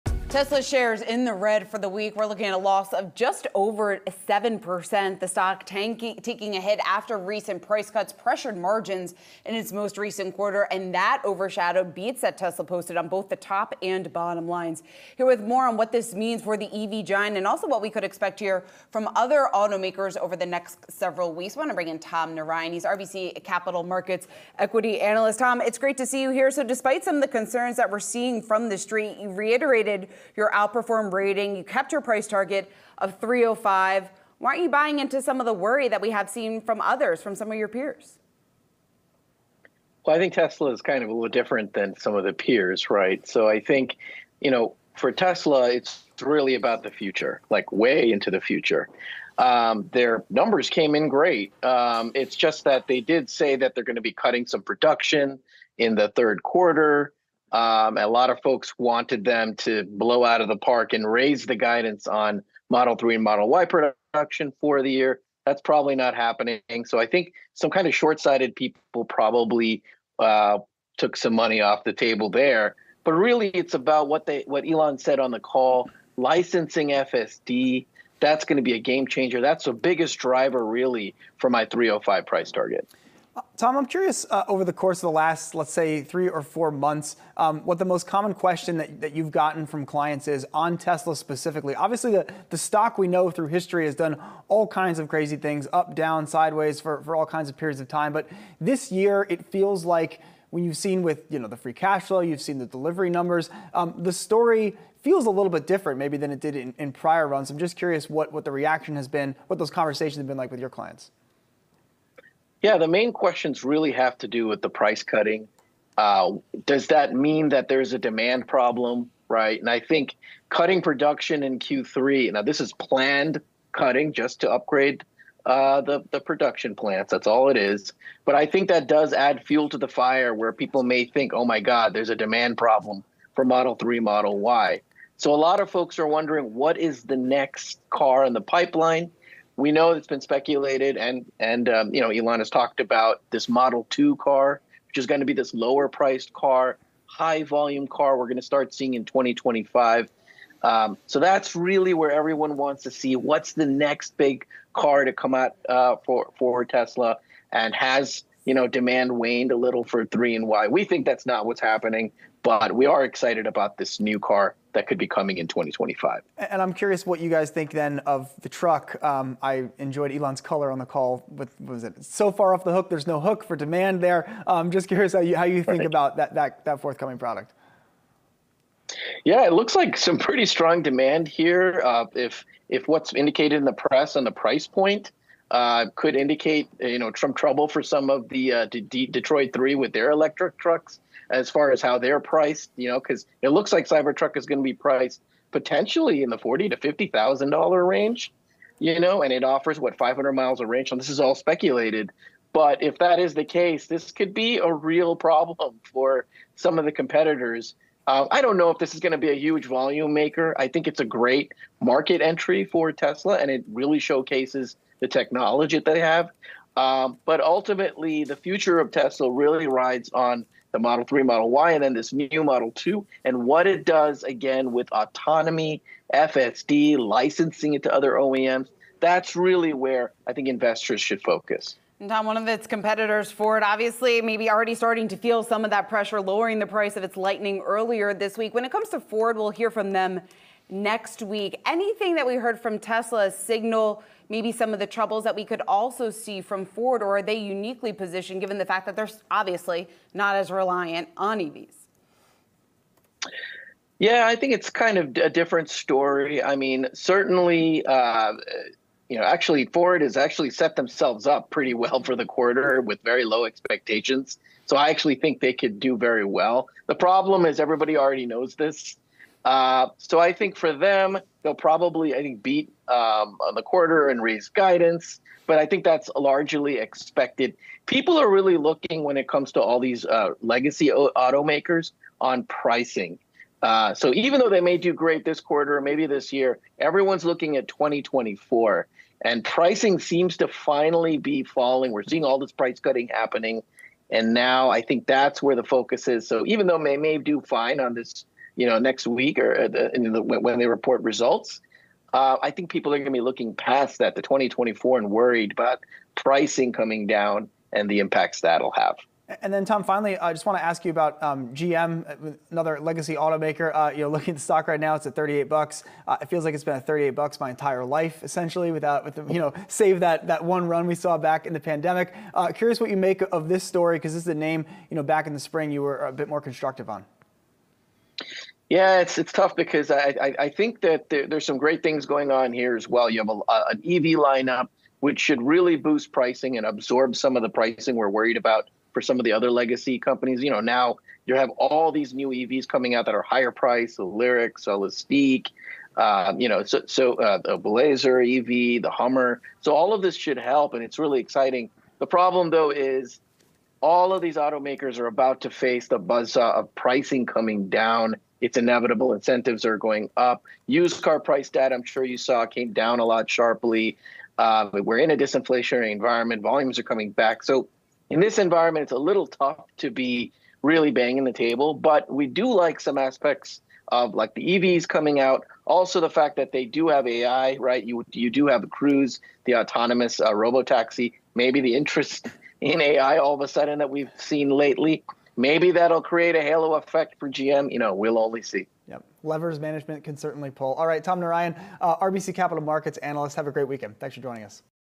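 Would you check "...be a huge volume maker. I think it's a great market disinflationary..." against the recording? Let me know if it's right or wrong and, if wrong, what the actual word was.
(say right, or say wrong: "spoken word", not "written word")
wrong: "entry", not "disinflationary".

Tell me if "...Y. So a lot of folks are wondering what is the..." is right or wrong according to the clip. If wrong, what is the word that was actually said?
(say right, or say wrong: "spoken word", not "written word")
right.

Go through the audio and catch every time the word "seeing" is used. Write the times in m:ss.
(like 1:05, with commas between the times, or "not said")
0:27, 2:28, 4:52.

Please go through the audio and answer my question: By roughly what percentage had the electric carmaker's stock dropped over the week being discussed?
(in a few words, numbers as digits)
just over 7%.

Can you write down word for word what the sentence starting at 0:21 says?
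I want to bring in Tom Narayan.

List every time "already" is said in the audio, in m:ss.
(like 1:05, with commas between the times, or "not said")
3:54, 4:27.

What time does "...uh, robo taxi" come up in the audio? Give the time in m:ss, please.
6:20.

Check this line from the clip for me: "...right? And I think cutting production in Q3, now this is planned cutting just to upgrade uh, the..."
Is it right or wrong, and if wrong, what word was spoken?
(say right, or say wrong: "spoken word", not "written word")
right.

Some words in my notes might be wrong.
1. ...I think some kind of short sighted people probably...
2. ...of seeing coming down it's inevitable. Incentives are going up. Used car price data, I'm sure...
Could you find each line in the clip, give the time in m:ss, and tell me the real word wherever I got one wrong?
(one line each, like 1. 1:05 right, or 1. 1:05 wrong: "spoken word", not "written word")
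1. 1:06 right
2. 5:56 wrong: "pricing", not "seeing".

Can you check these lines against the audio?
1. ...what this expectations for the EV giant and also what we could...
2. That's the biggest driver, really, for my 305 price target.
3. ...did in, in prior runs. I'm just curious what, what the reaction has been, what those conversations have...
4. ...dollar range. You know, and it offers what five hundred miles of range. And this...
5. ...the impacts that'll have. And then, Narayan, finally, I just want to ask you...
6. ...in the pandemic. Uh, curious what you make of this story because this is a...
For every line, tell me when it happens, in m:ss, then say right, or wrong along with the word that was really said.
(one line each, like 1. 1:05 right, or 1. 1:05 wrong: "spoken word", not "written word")
1. 0:15 wrong: "means", not "expectations"
2. 1:19 right
3. 1:46 right
4. 3:17 right
5. 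5:07 wrong: "Tom", not "Narayan"
6. 5:21 right.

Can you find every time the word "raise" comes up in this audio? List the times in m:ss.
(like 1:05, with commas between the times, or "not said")
1:01, 4:34.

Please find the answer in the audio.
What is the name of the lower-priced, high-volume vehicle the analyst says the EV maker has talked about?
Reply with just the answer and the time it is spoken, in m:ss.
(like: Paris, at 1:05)
Model Two, at 2:23.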